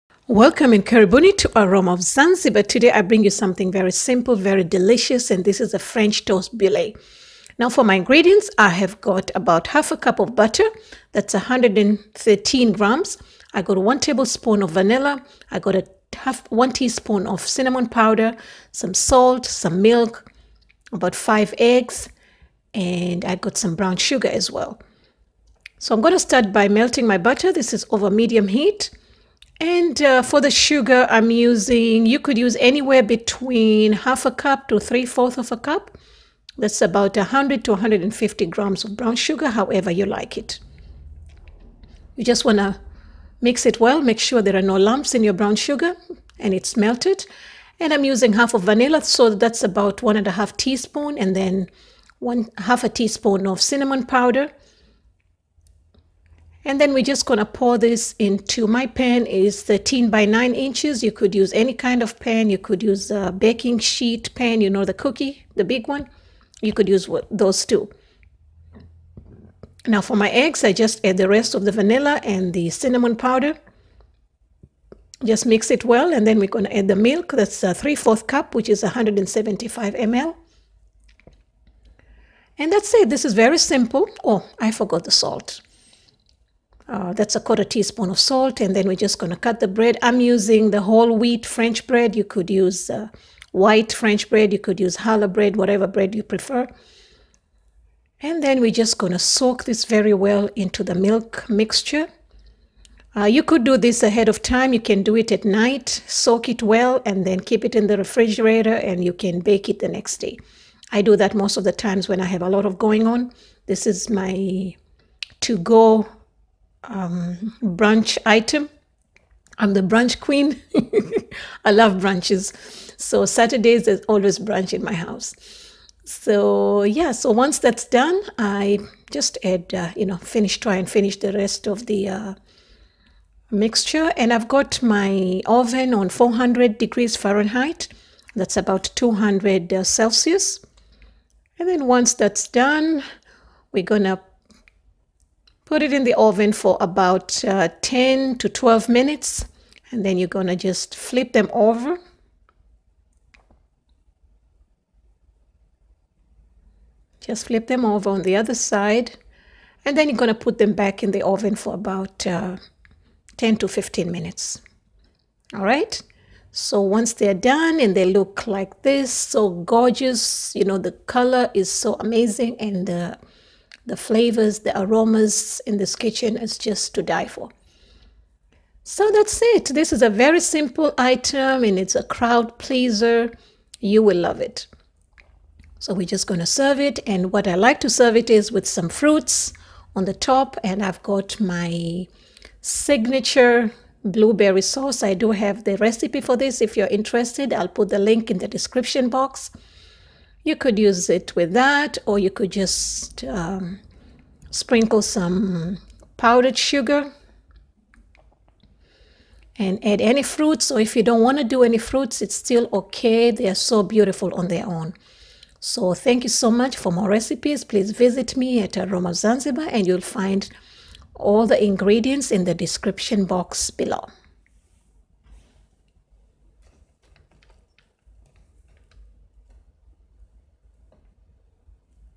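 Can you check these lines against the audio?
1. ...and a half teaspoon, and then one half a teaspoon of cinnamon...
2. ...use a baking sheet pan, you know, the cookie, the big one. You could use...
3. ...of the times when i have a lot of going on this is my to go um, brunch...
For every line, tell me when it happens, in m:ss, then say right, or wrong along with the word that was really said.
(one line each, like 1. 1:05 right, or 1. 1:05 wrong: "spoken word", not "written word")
1. 0:50 right
2. 1:02 right
3. 1:51 right.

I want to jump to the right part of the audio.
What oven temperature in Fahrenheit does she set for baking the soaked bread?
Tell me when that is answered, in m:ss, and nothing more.
2:16.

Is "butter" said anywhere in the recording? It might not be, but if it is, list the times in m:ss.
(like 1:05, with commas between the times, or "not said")
0:10, 0:27.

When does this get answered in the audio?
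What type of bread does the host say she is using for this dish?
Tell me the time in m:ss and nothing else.
1:30.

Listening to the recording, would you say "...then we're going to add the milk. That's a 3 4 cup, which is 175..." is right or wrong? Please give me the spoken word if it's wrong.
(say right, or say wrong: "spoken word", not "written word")
right.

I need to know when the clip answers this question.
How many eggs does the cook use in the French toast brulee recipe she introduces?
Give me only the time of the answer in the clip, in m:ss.
0:21.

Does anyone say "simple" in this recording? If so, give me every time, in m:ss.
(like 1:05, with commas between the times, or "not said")
0:03, 1:23, 3:00.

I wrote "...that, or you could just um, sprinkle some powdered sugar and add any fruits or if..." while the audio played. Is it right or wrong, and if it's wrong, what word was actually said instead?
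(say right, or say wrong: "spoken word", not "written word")
right.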